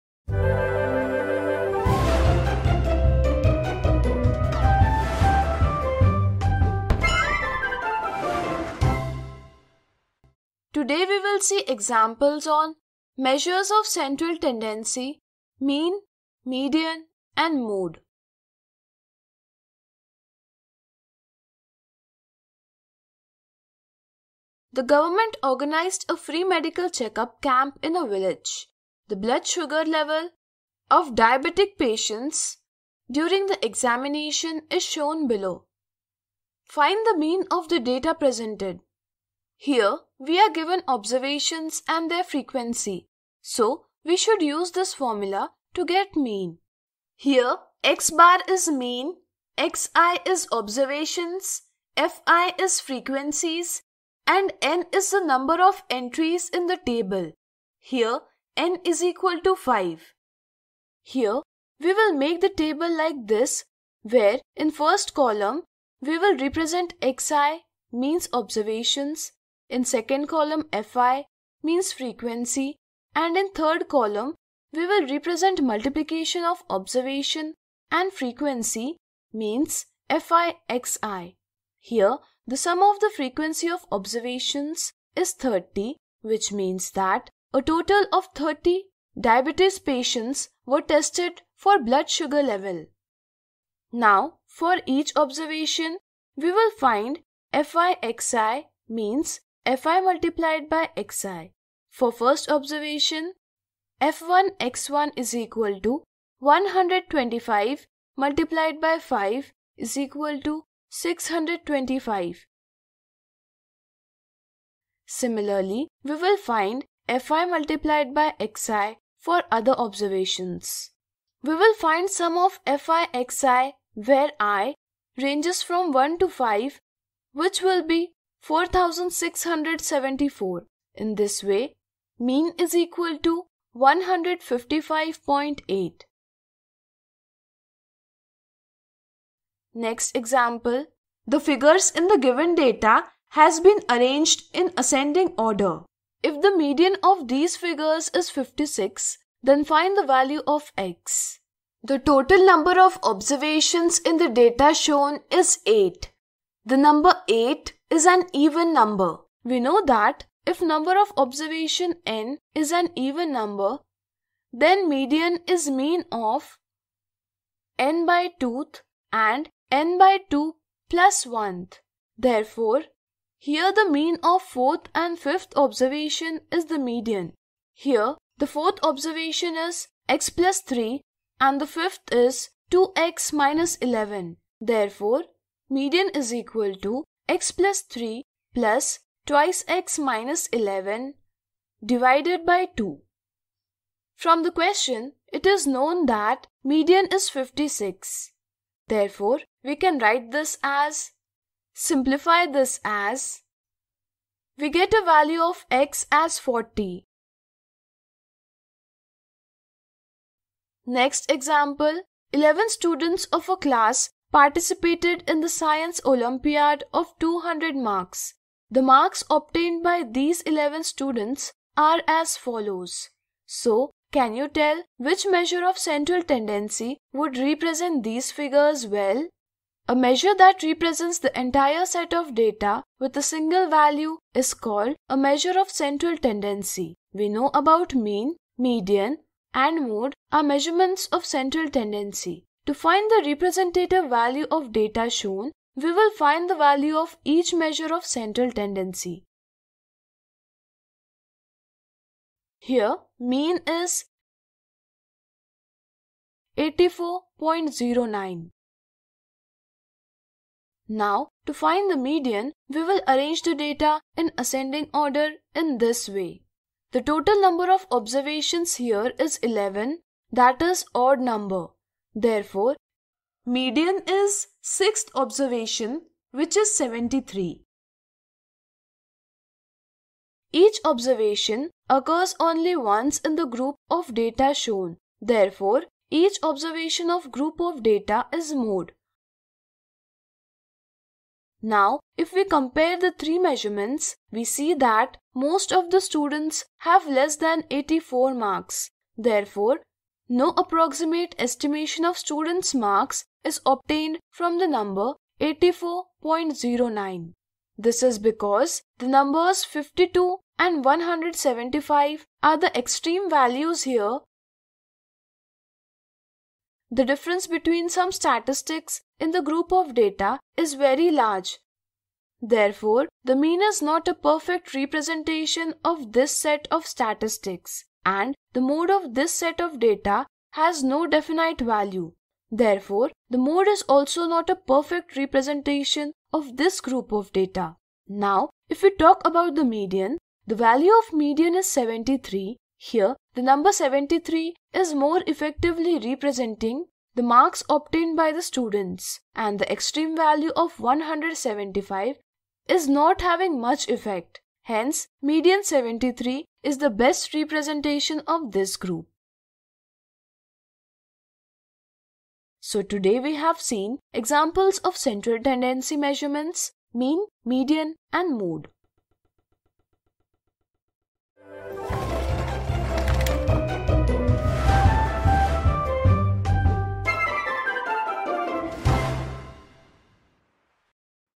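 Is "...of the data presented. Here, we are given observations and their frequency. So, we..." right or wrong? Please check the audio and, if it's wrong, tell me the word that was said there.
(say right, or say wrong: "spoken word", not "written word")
right.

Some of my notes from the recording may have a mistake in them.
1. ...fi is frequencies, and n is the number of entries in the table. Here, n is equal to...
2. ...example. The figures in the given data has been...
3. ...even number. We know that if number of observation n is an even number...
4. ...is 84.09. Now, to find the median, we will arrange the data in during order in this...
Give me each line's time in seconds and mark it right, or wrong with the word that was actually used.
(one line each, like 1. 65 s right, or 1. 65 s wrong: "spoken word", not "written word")
1. 51 s right
2. 140 s right
3. 158 s right
4. 253 s wrong: "ascending", not "during".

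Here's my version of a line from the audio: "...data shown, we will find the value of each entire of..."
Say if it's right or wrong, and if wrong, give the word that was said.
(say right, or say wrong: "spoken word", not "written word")
wrong: "measure", not "entire".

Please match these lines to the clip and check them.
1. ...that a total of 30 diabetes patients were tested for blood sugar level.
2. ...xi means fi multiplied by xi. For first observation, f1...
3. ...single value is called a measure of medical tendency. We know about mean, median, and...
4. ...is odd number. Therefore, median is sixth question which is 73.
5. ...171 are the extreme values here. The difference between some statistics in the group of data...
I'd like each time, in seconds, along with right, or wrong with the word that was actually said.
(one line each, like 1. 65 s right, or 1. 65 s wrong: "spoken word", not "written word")
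1. 86 s right
2. 98 s right
3. 233 s wrong: "central", not "medical"
4. 270 s wrong: "observation", not "question"
5. 310 s wrong: "175", not "171".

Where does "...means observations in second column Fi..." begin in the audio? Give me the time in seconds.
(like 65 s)
67 s.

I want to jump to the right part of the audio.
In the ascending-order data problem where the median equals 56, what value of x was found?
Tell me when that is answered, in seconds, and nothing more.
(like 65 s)
206 s.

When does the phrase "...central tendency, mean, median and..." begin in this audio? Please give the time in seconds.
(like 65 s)
13 s.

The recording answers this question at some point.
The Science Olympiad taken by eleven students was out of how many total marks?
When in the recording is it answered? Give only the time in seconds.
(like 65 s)
217 s.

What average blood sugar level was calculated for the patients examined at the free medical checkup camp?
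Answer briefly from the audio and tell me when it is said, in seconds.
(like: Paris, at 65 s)
155.8, at 133 s.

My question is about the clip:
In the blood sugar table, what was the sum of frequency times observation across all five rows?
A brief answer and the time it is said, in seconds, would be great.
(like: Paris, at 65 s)
4674, at 128 s.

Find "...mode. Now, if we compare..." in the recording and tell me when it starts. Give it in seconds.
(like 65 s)
288 s.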